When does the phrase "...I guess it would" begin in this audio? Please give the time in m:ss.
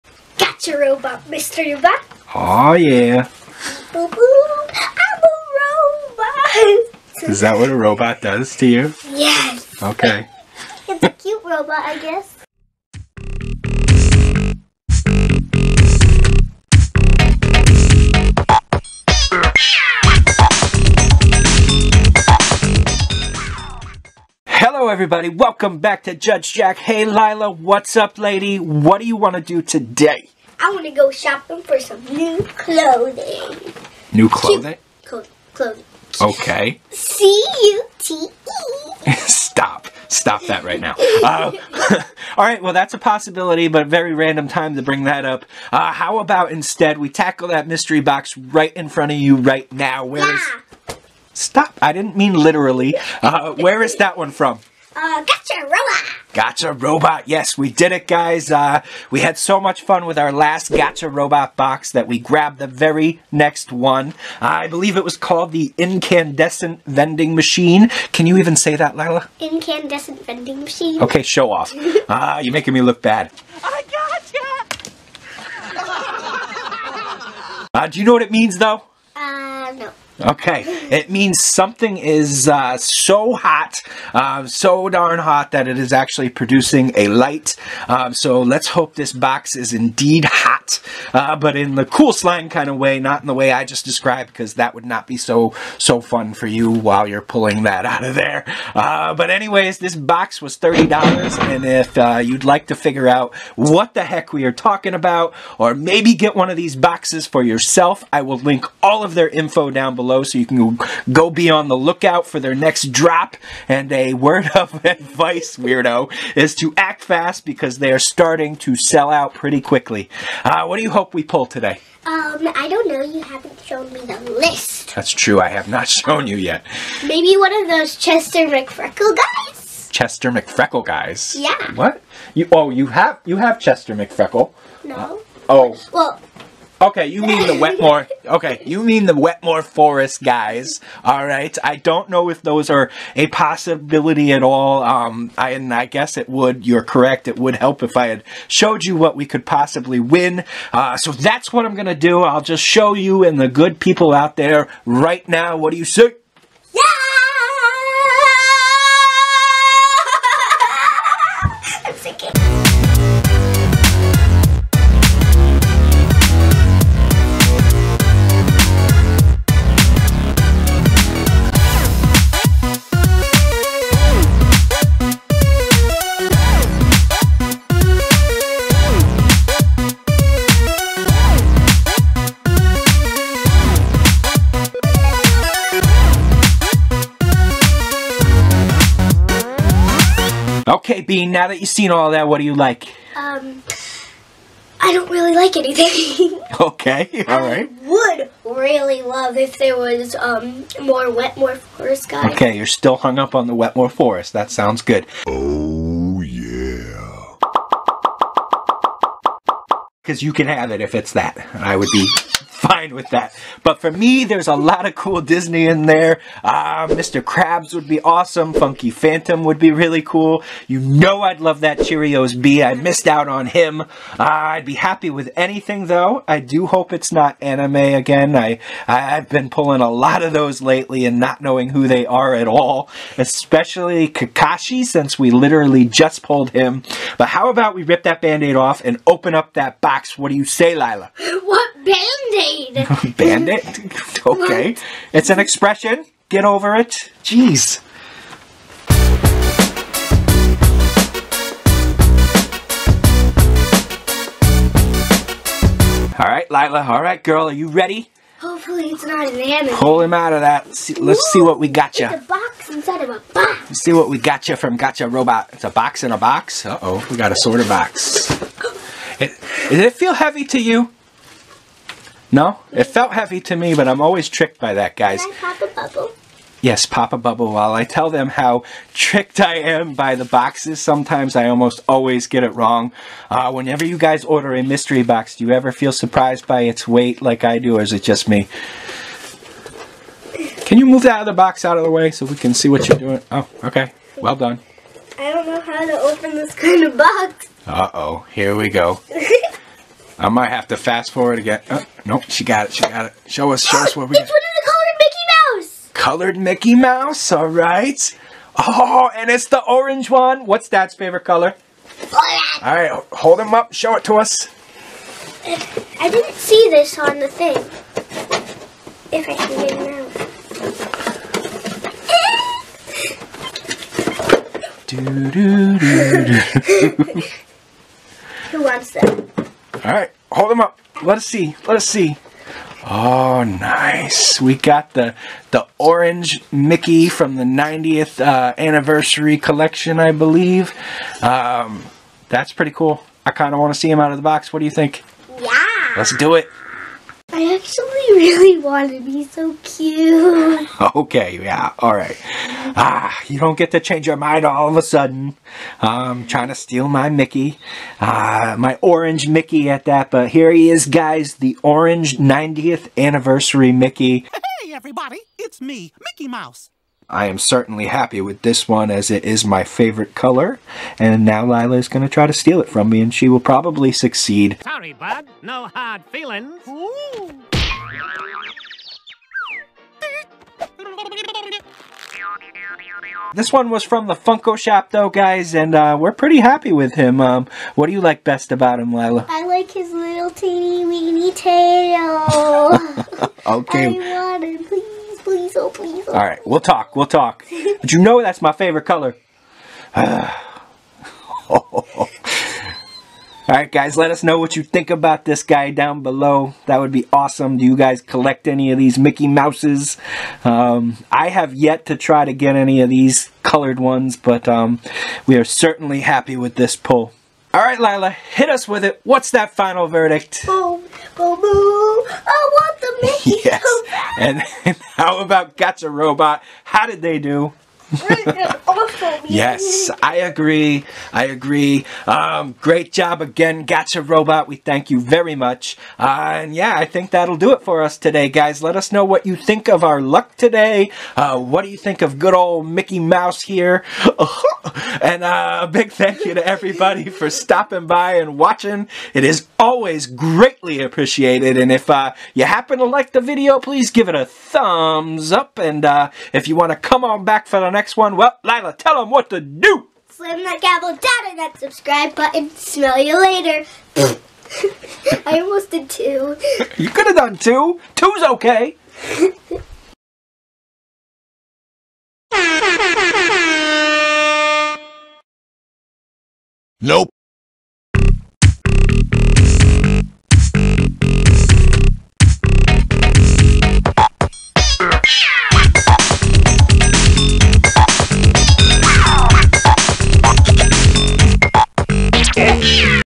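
2:25.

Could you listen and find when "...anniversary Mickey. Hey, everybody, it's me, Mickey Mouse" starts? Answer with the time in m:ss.
6:02.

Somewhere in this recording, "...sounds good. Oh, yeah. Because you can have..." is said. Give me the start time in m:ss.
3:24.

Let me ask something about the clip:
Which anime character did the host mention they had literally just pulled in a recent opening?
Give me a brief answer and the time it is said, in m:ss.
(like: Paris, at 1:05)
Kakashi, at 3:54.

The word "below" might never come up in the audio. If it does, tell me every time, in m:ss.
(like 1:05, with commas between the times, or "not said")
1:49, 6:46.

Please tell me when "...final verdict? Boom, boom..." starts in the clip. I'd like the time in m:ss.
6:59.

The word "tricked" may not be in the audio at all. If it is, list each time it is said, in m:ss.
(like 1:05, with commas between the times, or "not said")
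4:34, 4:38.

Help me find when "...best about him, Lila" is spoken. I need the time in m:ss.
6:28.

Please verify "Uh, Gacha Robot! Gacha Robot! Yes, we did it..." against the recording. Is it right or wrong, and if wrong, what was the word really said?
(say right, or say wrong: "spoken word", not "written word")
right.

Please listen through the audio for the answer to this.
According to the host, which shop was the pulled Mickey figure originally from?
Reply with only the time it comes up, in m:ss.
6:24.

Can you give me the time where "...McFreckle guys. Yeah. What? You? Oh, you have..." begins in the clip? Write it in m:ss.
2:10.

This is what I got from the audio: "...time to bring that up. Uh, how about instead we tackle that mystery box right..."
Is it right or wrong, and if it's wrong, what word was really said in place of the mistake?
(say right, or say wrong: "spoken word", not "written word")
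right.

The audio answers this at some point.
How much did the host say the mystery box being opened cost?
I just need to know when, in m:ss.
1:40.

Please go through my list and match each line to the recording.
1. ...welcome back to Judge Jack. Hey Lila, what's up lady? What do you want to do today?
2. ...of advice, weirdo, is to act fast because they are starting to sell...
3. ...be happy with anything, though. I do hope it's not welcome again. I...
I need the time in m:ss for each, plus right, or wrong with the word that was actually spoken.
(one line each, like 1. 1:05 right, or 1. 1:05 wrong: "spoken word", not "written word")
1. 0:25 right
2. 1:54 right
3. 3:44 wrong: "anime", not "welcome".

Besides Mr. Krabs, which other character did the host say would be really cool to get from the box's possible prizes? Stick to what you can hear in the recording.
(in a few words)
Funky Phantom.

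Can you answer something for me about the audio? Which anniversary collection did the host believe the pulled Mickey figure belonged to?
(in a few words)
90th anniversary.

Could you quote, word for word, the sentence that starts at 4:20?
Let's see, let's see what we got you.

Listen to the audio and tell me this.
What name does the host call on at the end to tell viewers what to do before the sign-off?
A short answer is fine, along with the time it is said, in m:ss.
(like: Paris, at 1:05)
Skylar, at 7:38.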